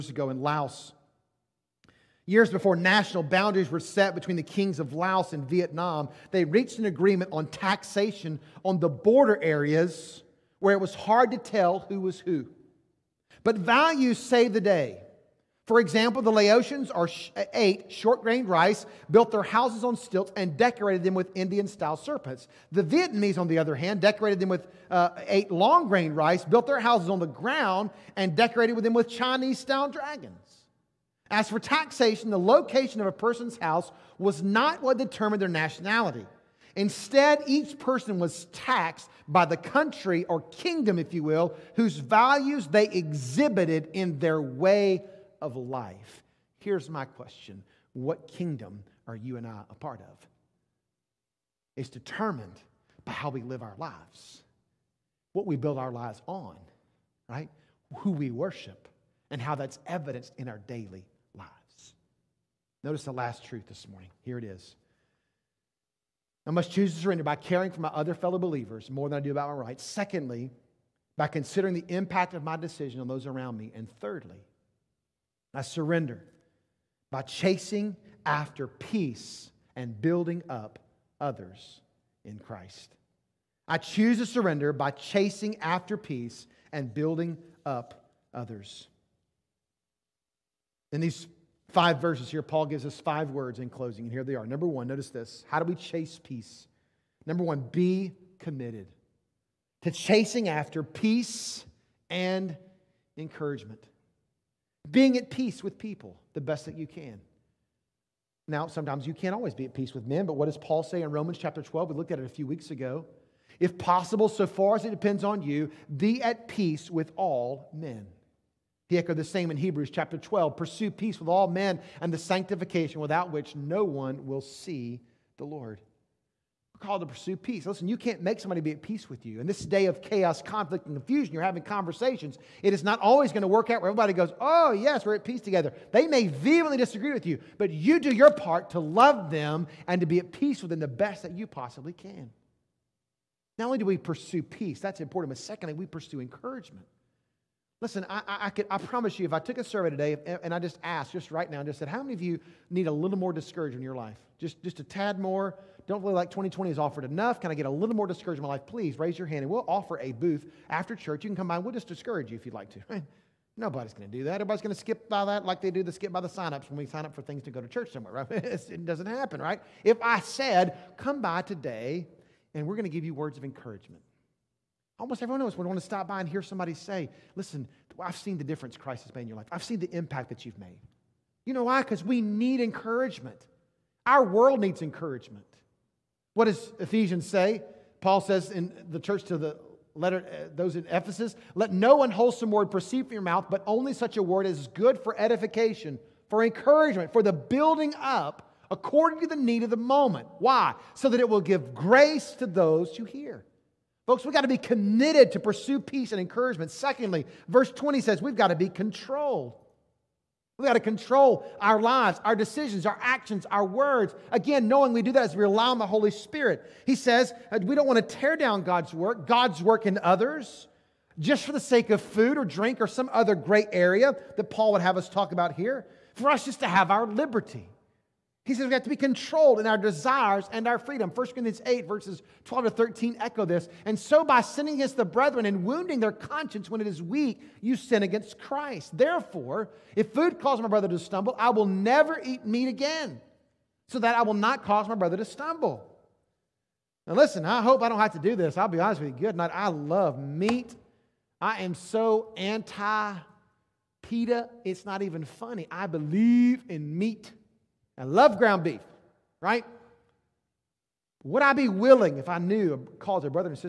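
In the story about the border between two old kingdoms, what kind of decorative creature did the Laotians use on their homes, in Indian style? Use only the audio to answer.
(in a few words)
serpents.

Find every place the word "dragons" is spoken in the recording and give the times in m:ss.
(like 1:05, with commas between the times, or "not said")
0:29.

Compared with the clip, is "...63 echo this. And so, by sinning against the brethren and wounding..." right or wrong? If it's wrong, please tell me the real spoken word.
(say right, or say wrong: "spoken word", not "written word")
wrong: "13", not "63".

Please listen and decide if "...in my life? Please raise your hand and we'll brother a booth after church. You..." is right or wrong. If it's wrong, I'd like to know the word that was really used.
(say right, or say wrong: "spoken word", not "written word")
wrong: "offer", not "brother".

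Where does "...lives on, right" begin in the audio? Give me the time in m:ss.
0:55.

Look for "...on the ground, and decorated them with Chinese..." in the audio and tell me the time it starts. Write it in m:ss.
0:27.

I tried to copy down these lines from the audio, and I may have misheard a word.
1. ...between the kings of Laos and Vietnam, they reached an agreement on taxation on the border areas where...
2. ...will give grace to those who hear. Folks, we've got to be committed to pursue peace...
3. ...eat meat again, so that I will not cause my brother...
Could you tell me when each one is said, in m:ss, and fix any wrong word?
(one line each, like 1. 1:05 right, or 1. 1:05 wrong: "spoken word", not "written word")
1. 0:04 right
2. 3:21 right
3. 4:02 right.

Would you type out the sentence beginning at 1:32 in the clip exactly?
Paul gives us five words in closing, and here they are.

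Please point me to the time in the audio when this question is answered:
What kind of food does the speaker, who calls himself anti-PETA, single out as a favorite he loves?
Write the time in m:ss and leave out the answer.
4:18.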